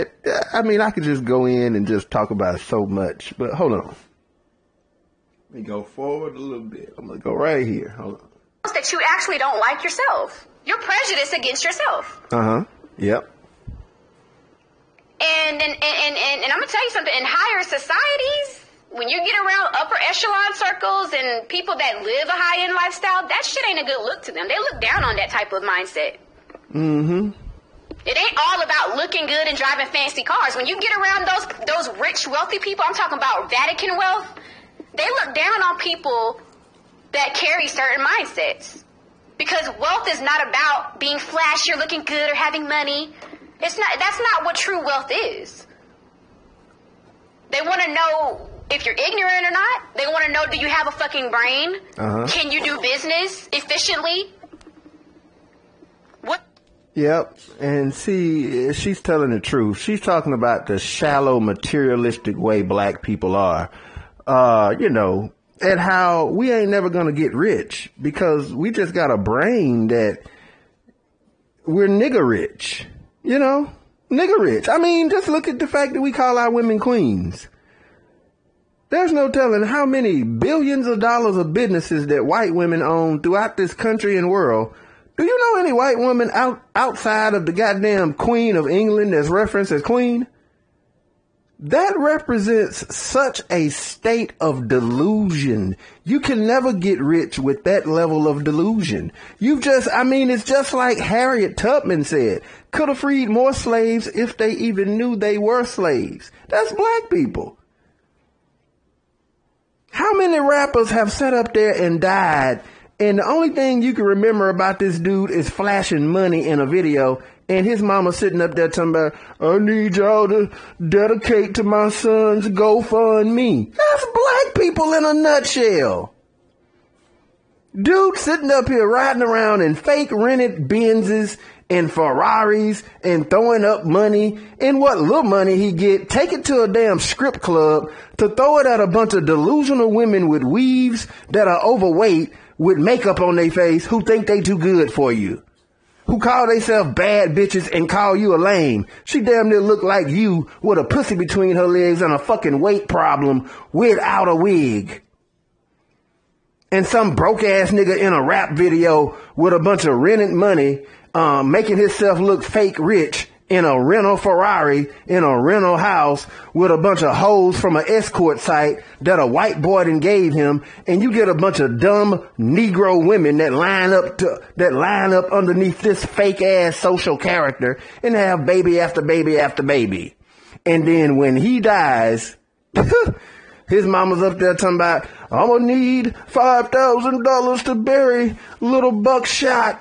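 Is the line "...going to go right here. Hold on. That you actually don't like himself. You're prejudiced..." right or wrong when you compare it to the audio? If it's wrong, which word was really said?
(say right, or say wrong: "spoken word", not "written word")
wrong: "yourself", not "himself".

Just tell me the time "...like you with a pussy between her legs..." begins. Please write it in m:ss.
2:29.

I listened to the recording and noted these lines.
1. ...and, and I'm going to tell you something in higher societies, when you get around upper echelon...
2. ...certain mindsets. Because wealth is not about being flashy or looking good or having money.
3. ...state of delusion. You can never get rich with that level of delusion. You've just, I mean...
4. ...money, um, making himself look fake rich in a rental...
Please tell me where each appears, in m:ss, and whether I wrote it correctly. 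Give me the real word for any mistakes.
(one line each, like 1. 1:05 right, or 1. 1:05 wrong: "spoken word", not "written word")
1. 0:16 right
2. 0:37 right
3. 1:33 right
4. 2:40 right.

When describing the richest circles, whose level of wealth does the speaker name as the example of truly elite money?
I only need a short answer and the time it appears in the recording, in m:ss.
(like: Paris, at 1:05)
Vatican, at 0:33.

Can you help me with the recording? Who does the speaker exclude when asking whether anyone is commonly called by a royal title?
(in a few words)
Queen of England.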